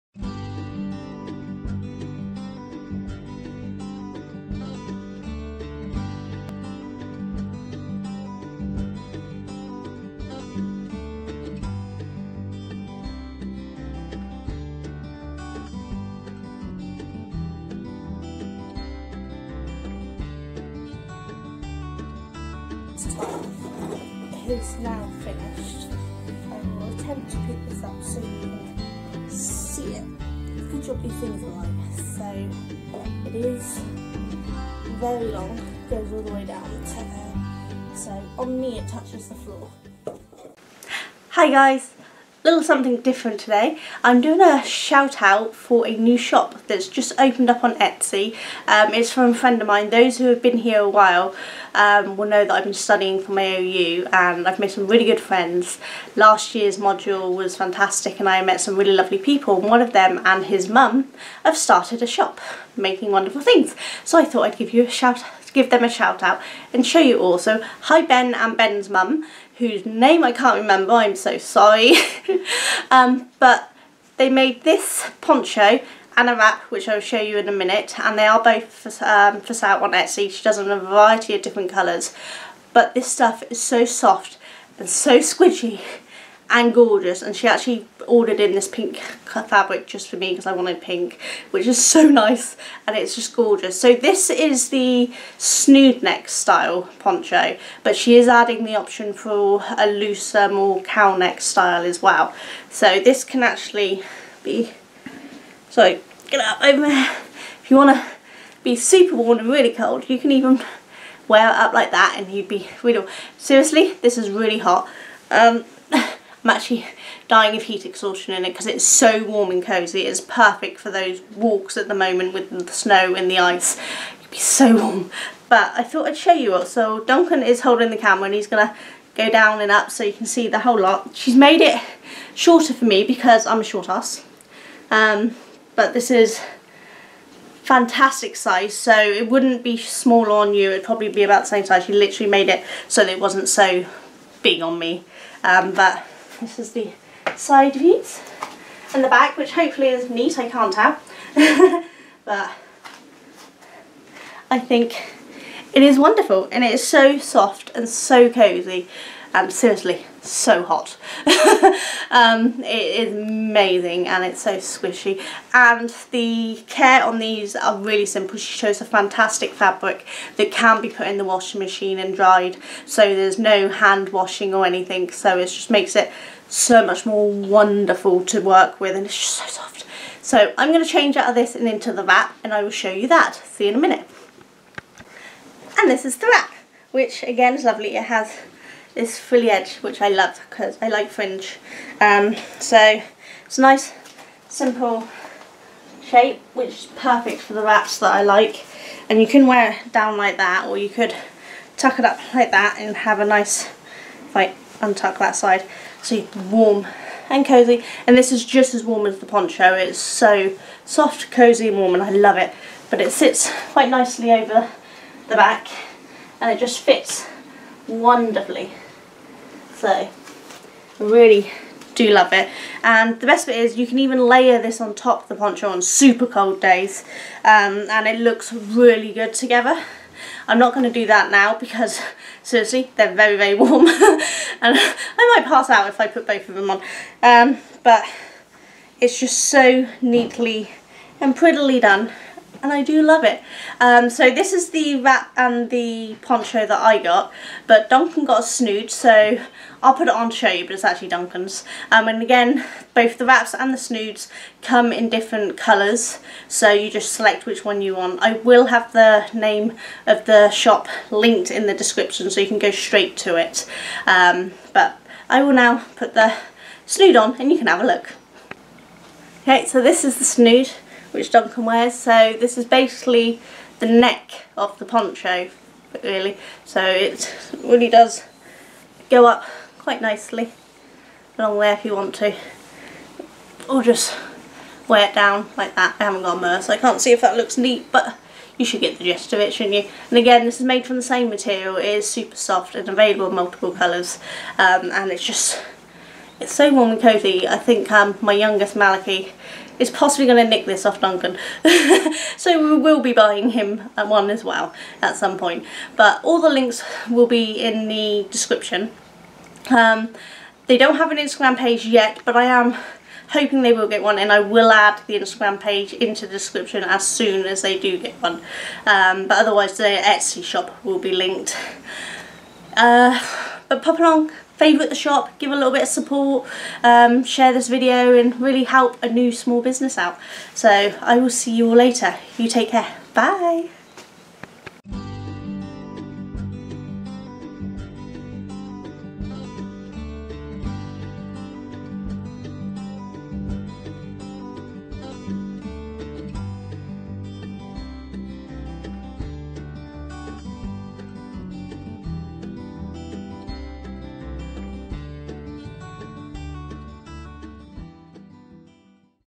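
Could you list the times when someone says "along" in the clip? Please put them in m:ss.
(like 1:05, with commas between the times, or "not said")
4:41, 5:23.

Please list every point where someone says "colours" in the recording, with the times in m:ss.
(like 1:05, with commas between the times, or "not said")
1:21, 4:15, 4:53.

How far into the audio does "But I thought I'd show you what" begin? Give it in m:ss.
2:05.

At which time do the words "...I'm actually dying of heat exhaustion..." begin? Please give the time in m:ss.
1:56.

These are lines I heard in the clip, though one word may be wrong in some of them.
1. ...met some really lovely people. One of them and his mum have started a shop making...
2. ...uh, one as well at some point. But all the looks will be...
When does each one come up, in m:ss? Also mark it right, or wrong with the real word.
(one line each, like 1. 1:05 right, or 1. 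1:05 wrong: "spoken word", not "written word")
1. 0:58 right
2. 5:03 wrong: "links", not "looks".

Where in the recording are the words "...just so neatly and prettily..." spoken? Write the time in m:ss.
3:59.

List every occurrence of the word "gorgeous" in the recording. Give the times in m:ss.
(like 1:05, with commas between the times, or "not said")
1:26, 1:33.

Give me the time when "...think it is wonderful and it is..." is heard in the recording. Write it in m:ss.
2:34.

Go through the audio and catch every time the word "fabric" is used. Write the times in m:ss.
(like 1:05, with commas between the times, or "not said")
1:29, 2:49.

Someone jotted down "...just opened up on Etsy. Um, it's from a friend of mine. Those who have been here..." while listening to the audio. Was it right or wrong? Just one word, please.
right.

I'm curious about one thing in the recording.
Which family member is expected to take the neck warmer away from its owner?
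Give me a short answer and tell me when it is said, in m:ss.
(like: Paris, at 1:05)
Malachi, at 4:58.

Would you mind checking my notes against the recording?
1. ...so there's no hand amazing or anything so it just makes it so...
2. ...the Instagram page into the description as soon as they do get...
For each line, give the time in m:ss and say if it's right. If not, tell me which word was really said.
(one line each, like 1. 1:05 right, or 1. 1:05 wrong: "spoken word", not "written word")
1. 2:52 wrong: "washing", not "amazing"
2. 5:15 right.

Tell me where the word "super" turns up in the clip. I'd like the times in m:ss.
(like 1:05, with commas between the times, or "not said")
1:48, 3:45, 4:52.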